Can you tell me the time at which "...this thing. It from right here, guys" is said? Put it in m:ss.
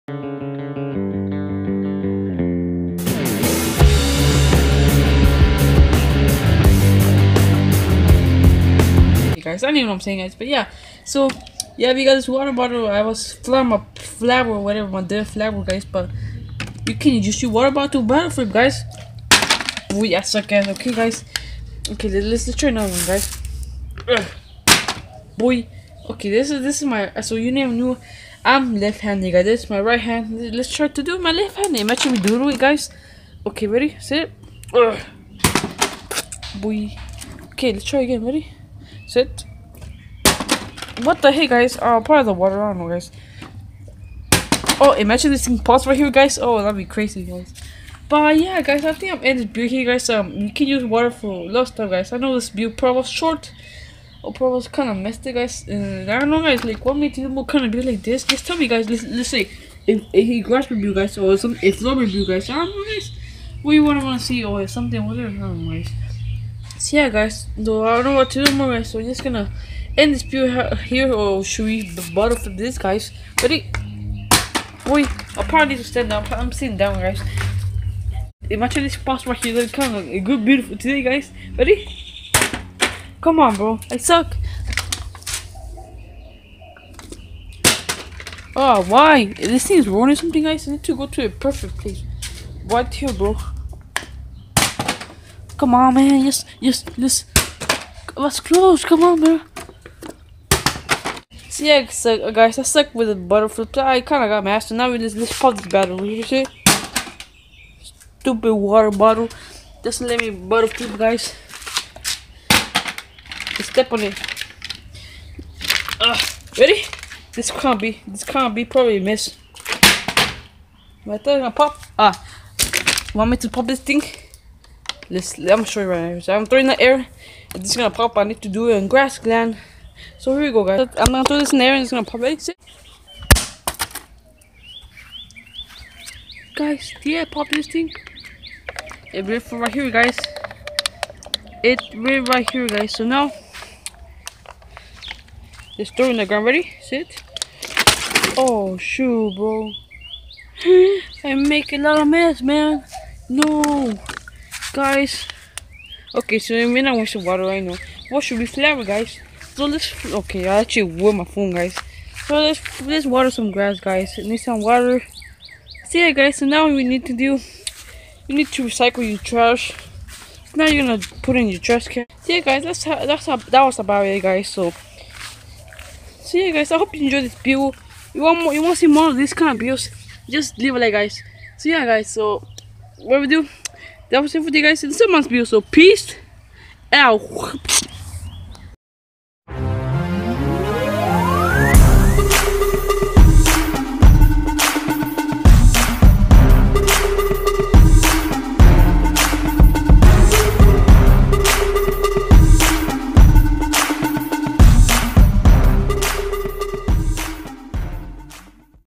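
2:17.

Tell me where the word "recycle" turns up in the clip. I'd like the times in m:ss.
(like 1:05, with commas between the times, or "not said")
2:48.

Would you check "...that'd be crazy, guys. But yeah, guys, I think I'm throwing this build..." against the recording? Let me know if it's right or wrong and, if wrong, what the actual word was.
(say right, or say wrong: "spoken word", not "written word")
wrong: "ending", not "throwing".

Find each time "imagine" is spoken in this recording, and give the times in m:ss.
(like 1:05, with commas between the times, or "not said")
0:31, 0:44, 1:18.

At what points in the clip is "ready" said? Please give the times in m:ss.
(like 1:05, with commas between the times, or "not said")
0:33, 0:38, 1:13, 1:21, 1:56, 2:26.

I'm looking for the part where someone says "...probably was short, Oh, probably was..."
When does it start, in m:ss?
0:52.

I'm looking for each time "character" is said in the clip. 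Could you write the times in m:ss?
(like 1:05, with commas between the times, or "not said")
not said.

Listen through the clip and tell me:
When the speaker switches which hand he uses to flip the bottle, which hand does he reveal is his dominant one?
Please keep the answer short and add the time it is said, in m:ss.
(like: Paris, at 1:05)
Left, at 0:28.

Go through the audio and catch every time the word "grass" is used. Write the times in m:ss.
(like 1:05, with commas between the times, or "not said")
1:00, 2:08, 2:43.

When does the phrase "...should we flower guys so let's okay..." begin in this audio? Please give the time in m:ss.
2:38.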